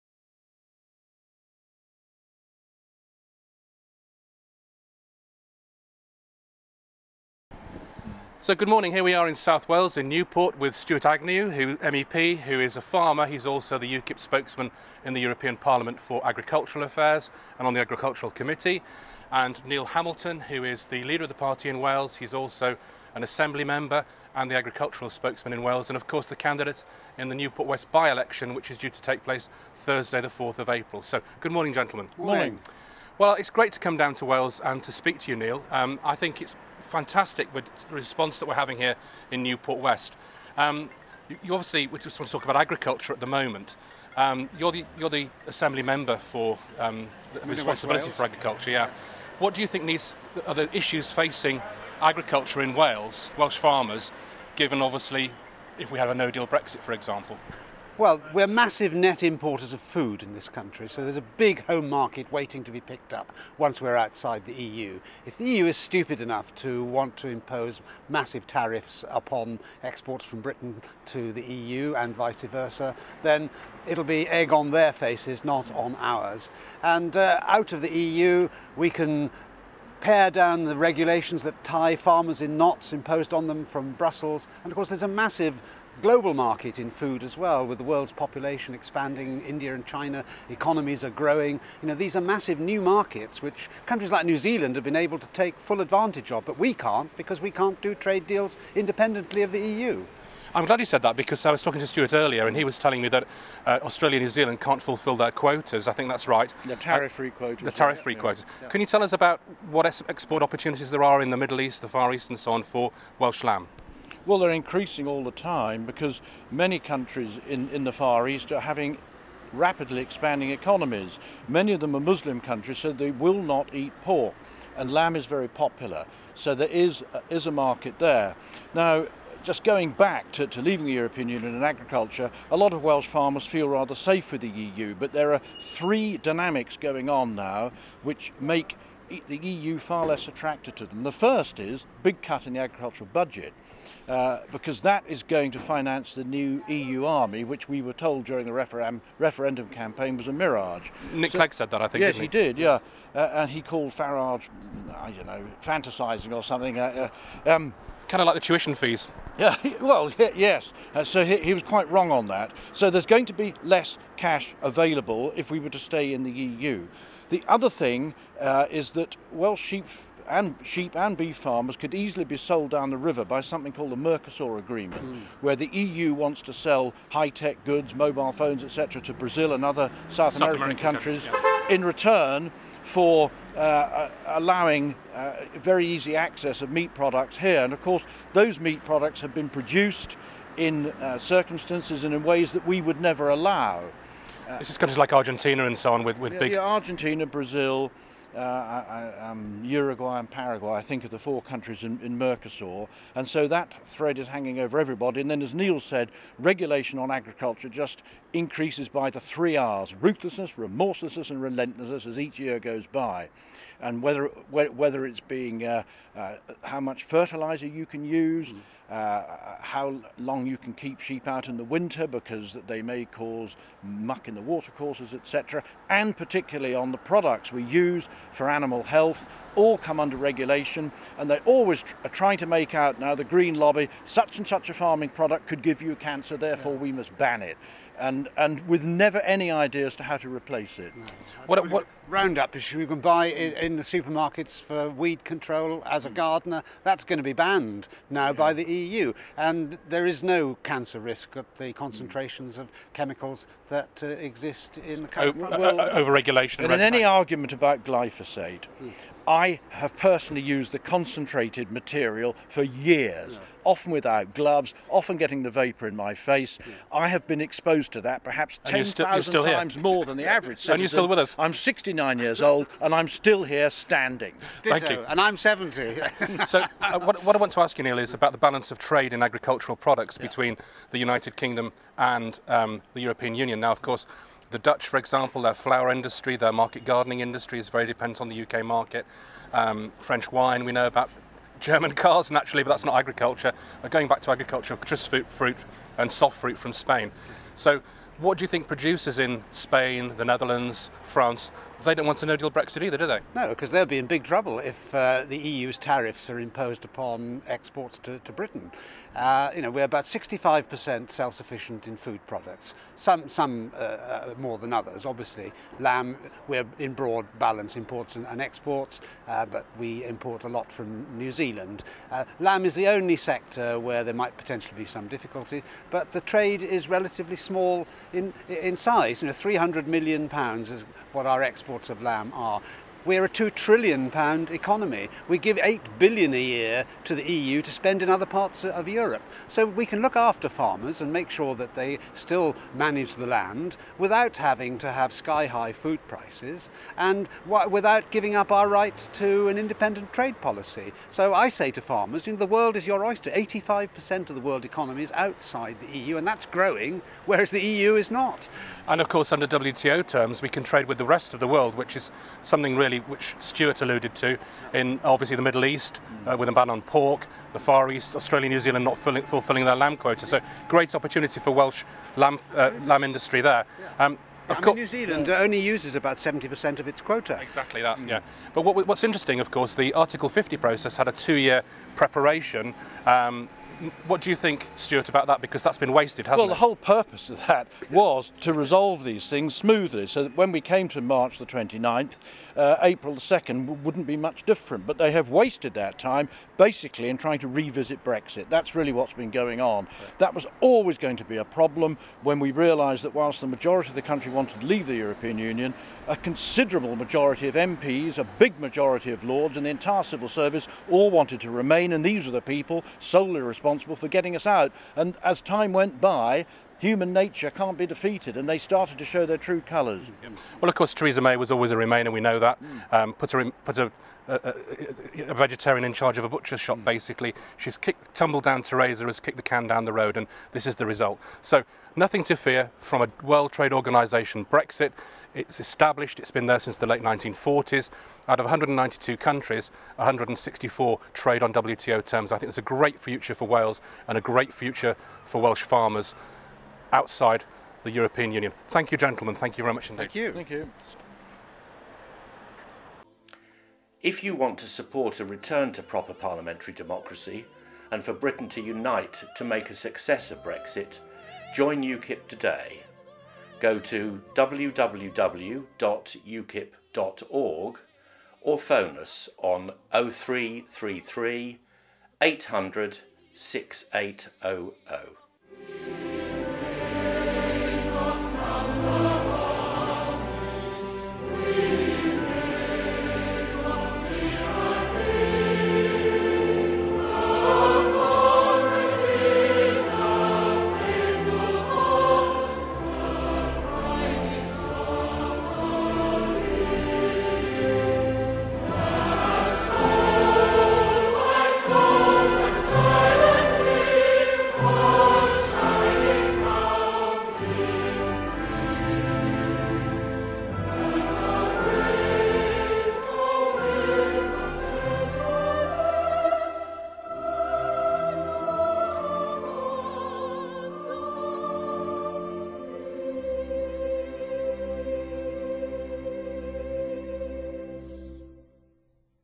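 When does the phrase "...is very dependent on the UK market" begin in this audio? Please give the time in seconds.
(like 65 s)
287 s.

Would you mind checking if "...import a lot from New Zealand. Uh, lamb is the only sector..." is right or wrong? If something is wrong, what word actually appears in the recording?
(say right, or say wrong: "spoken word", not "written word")
right.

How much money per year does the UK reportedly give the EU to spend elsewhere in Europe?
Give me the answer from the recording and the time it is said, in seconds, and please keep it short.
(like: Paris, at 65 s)
£8 billion, at 335 s.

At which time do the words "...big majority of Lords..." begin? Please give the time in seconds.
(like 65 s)
408 s.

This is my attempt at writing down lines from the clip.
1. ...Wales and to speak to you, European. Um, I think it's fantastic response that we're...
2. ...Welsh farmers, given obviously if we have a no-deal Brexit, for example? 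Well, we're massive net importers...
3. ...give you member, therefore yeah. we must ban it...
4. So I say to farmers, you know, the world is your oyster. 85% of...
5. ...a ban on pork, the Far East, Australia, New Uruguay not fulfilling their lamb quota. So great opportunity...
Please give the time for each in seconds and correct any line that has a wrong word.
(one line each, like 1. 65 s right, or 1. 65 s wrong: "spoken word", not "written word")
1. 34 s wrong: "Neil", not "European"
2. 53 s right
3. 235 s wrong: "cancer", not "member"
4. 351 s right
5. 366 s wrong: "Zealand", not "Uruguay".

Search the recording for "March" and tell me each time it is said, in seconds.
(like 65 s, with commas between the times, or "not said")
391 s.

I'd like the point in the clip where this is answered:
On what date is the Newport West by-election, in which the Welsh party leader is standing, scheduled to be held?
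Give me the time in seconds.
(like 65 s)
29 s.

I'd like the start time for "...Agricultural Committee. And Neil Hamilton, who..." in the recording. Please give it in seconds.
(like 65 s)
17 s.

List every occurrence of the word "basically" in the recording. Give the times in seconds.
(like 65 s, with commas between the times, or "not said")
396 s, 426 s.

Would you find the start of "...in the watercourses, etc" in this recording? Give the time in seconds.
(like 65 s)
224 s.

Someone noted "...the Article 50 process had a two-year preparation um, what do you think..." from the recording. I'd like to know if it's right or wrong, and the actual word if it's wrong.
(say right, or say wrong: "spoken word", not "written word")
right.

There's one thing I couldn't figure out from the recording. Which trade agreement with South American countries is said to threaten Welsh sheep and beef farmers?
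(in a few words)
Mercosur Agreement.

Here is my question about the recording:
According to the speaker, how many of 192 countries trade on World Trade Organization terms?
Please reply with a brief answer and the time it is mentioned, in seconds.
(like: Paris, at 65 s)
164, at 439 s.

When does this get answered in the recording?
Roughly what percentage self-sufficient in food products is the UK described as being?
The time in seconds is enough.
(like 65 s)
310 s.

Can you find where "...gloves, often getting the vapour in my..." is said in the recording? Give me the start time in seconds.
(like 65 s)
264 s.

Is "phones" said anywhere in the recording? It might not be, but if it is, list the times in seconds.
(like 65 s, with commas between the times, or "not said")
178 s, 468 s.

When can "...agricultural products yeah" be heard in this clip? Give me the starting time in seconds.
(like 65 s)
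279 s.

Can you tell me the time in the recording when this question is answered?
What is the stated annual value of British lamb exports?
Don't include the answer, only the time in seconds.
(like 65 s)
329 s.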